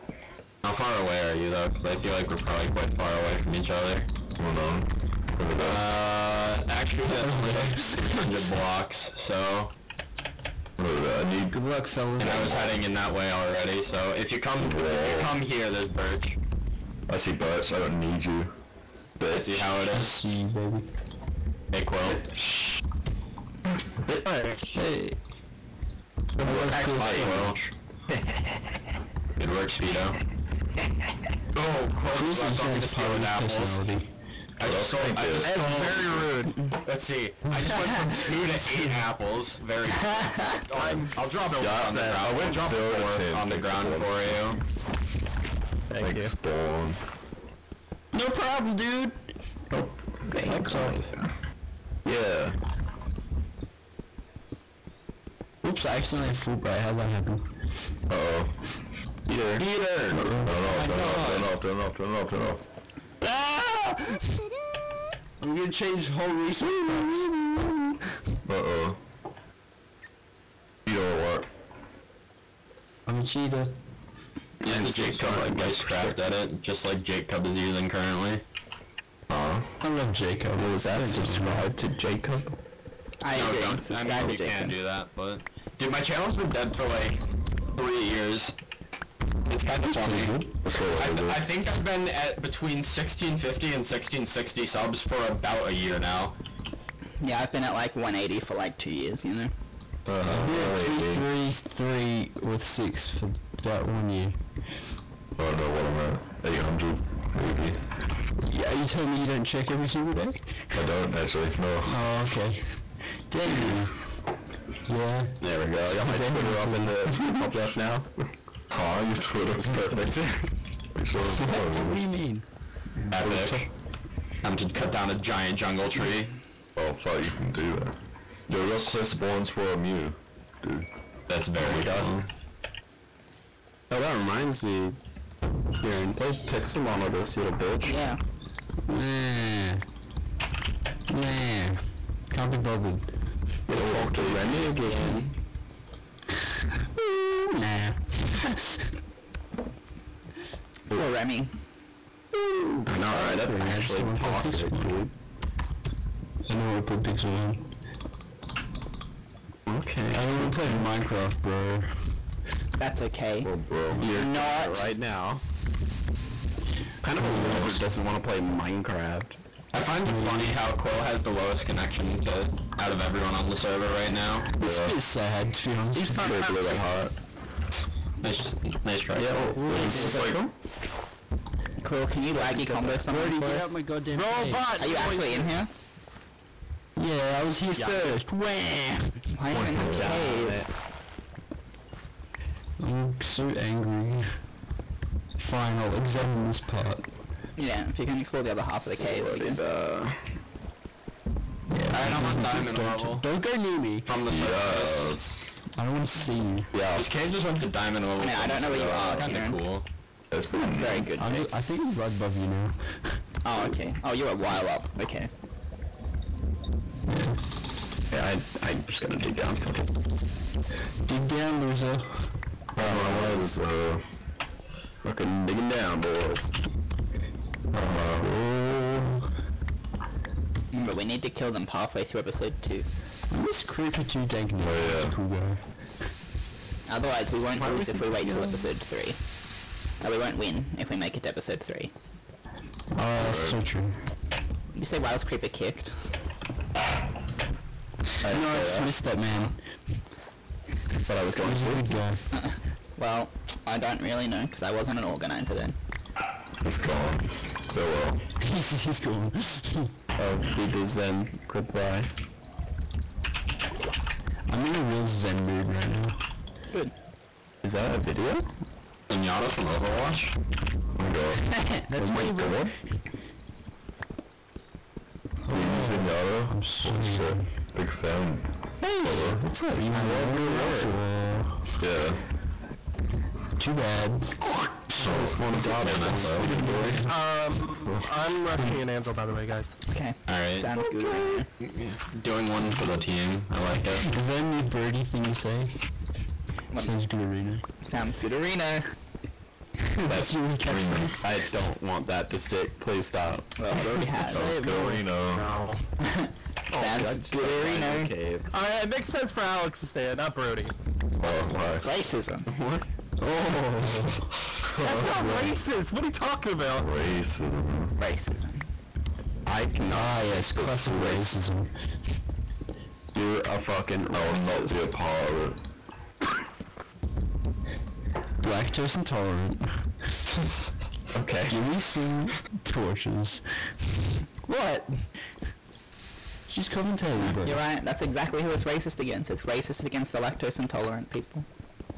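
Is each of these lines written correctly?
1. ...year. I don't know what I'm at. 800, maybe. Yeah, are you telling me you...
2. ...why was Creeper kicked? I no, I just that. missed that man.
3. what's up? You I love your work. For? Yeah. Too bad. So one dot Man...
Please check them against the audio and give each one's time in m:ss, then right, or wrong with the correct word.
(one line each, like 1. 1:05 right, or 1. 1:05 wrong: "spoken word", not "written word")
1. 1:44 right
2. 4:04 right
3. 4:39 right.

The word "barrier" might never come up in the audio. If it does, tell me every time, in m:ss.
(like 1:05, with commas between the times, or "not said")
not said.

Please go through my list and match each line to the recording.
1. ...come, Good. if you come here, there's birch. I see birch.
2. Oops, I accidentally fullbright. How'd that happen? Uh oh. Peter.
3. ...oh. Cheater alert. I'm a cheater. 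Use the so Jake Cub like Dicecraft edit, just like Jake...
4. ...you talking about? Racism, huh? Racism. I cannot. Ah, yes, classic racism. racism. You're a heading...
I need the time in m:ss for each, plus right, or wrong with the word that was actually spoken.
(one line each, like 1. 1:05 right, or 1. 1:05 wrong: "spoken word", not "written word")
1. 0:14 wrong: "Whoa", not "Good"
2. 0:55 right
3. 1:08 right
4. 5:16 wrong: "fucking", not "heading".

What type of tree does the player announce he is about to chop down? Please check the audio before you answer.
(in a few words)
Giant jungle tree.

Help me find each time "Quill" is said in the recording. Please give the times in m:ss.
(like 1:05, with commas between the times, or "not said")
0:21, 0:31, 2:50, 3:01.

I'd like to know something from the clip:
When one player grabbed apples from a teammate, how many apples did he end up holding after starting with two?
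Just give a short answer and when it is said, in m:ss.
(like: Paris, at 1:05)
8, at 0:38.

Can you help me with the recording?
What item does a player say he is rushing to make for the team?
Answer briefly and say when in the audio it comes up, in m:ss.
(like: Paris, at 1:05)
An anvil, at 4:48.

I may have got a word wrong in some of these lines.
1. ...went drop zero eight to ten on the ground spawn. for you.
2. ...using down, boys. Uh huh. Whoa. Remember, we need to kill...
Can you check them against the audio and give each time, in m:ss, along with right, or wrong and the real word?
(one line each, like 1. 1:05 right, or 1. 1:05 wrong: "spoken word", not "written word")
1. 0:42 wrong: "four", not "eight"
2. 3:45 wrong: "digging", not "using".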